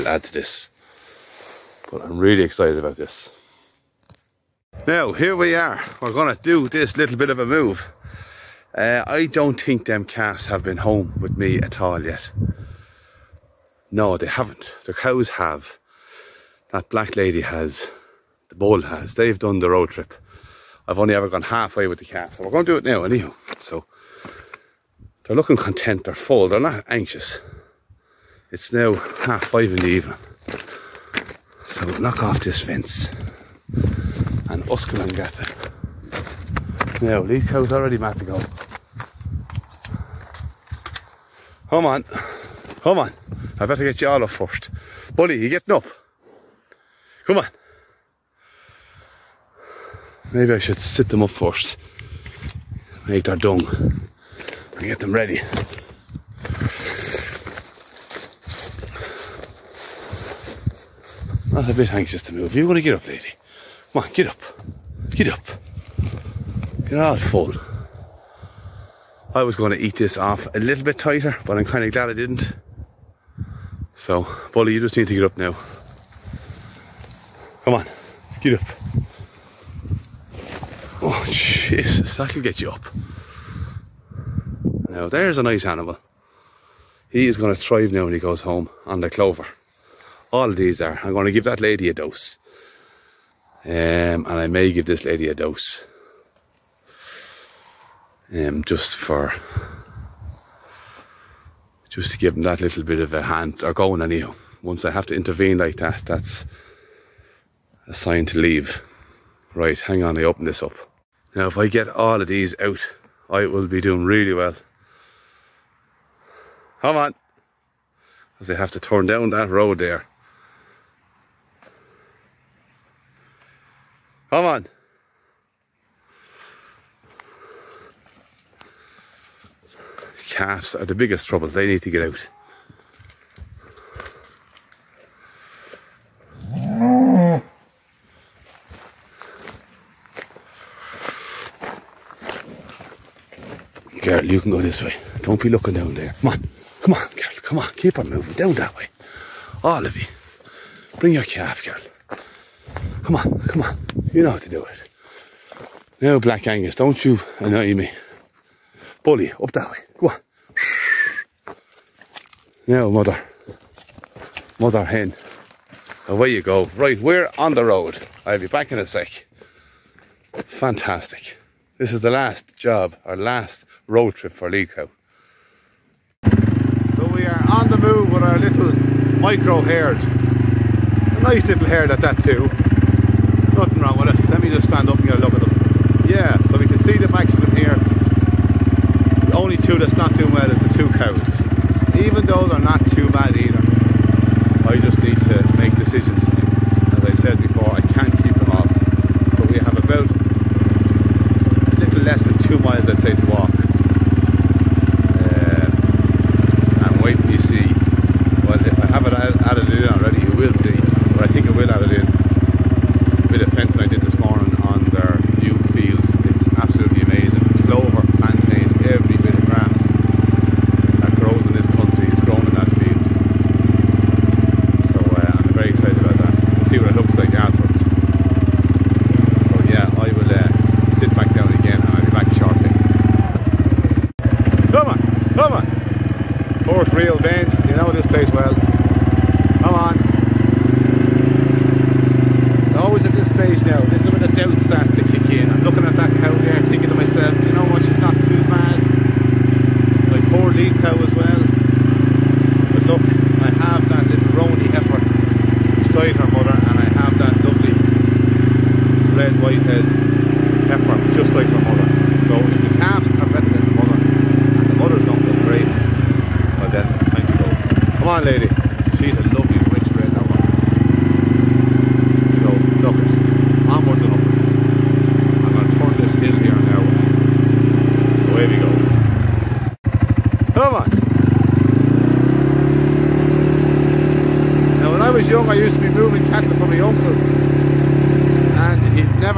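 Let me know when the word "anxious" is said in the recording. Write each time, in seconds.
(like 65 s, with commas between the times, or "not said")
26 s, 61 s.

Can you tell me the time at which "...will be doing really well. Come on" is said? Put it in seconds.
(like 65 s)
113 s.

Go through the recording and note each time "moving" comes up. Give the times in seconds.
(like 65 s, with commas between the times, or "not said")
148 s, 285 s.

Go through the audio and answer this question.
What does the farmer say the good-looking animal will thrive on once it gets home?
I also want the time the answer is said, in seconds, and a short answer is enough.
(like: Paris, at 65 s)
clover, at 89 s.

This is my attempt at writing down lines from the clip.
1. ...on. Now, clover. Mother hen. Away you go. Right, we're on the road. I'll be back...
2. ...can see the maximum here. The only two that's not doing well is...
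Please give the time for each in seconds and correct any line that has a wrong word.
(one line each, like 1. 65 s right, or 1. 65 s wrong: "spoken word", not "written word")
1. 160 s wrong: "mother", not "clover"
2. 186 s right.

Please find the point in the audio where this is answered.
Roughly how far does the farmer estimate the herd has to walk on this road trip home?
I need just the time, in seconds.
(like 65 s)
200 s.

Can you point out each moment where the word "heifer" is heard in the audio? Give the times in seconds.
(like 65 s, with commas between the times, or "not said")
260 s.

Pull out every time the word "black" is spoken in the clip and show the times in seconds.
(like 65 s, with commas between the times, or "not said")
16 s, 156 s.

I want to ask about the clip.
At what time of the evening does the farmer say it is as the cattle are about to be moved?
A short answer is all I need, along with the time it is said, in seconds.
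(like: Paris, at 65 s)
half five, at 28 s.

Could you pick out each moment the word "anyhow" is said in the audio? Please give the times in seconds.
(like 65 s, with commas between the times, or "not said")
23 s, 104 s.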